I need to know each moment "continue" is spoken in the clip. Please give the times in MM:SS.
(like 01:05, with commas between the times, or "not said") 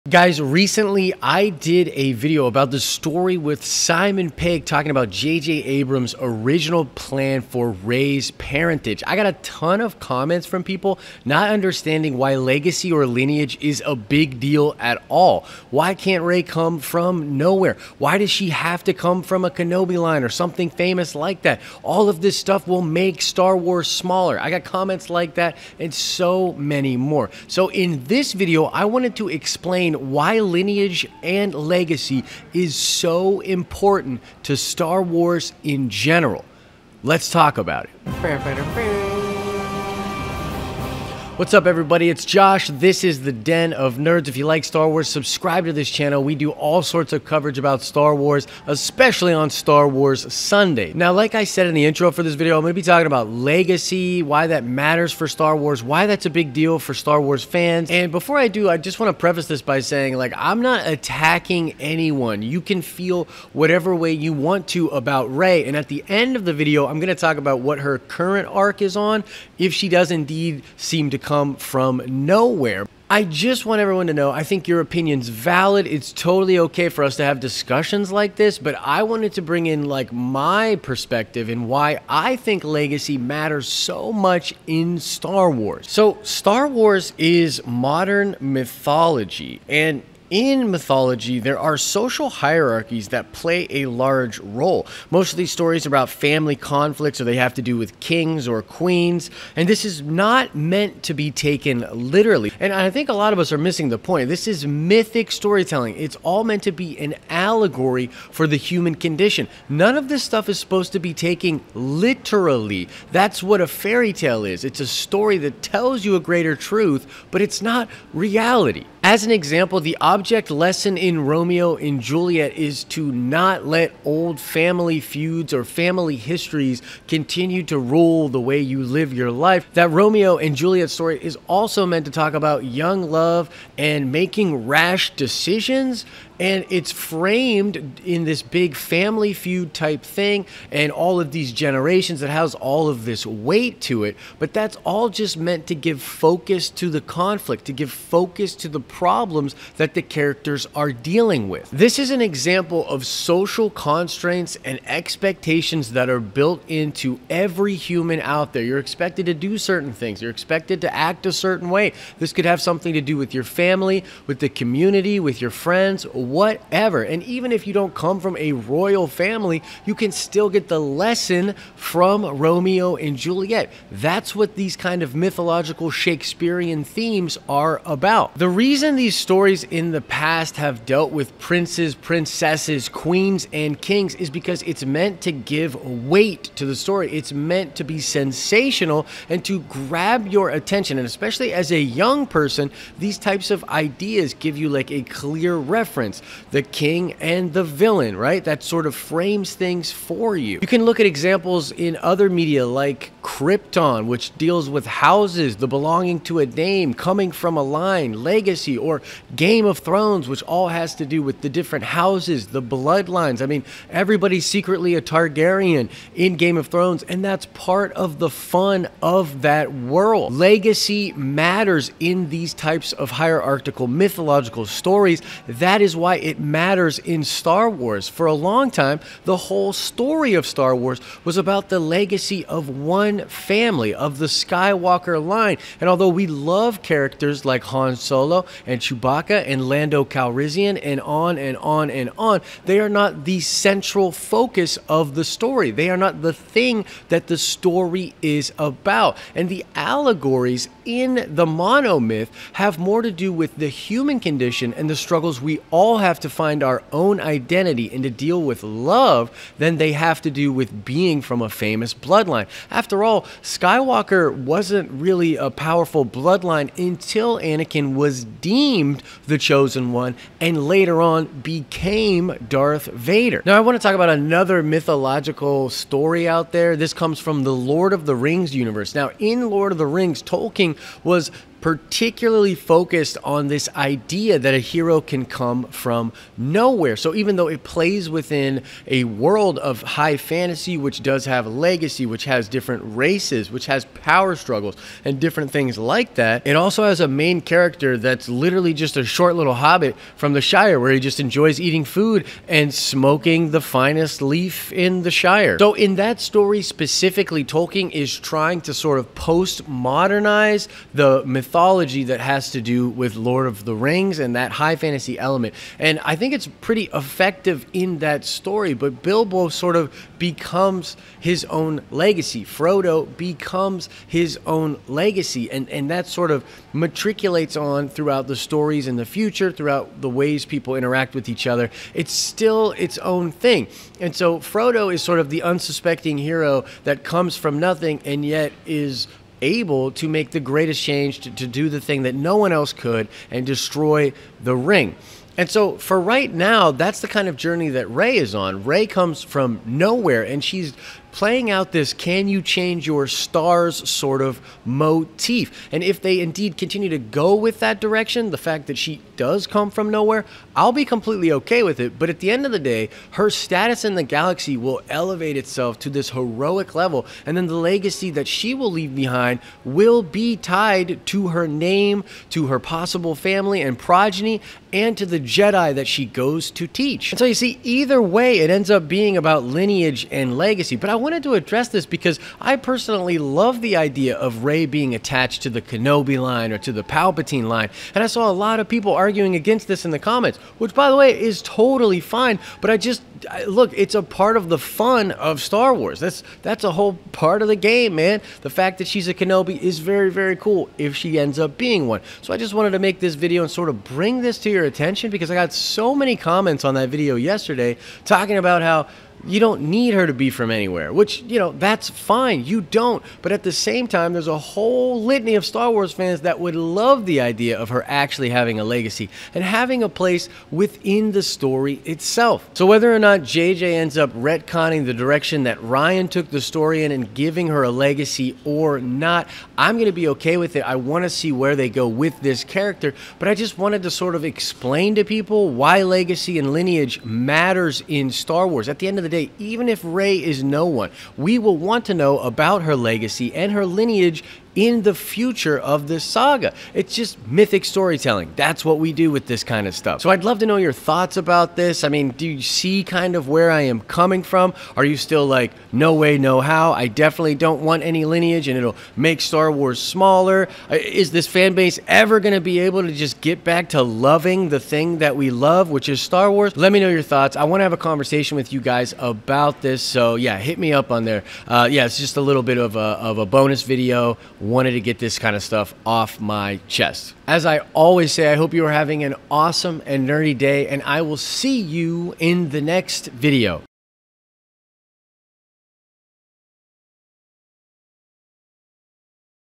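02:07, 05:56.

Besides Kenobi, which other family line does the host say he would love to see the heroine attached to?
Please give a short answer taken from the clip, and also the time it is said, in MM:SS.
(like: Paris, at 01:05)
Palpatine, at 06:26.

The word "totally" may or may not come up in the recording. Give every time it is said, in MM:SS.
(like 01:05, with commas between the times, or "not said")
01:16, 06:31.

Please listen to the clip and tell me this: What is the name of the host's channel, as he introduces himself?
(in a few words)
Den of Nerds.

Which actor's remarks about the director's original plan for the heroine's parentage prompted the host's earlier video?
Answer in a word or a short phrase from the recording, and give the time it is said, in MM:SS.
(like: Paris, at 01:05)
Simon Pegg, at 00:03.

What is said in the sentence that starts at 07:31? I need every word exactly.
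I mean, do you see kind of where I am coming from?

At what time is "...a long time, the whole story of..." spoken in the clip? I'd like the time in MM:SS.
03:48.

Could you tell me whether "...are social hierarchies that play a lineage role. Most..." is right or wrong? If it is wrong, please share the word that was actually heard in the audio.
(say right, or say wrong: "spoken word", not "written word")
wrong: "large", not "lineage".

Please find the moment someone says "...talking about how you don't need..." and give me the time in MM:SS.
06:48.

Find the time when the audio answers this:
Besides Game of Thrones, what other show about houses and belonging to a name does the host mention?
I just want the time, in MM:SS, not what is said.
03:23.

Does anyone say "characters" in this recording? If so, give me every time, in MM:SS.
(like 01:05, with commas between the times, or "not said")
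02:30, 03:56, 04:57, 07:12.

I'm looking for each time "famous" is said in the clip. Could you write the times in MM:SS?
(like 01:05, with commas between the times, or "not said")
00:20, 04:21.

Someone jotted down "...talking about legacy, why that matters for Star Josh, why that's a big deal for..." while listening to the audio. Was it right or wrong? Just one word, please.
wrong.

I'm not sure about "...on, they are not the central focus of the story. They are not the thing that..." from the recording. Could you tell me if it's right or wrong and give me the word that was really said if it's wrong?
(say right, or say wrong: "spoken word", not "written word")
right.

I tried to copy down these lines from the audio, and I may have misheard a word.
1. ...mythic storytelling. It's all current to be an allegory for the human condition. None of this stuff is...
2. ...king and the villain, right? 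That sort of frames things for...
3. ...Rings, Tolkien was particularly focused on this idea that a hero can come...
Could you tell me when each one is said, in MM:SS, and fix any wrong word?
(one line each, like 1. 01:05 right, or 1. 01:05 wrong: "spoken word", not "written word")
1. 01:44 wrong: "meant", not "current"
2. 03:16 right
3. 04:39 right.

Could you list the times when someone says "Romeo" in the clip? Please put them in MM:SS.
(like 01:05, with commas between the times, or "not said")
02:01, 02:09, 02:52.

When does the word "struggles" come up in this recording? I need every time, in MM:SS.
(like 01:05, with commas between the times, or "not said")
04:14, 04:54.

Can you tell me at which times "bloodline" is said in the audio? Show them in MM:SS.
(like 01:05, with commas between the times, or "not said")
03:32, 04:21, 04:26.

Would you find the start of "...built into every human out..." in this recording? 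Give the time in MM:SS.
02:36.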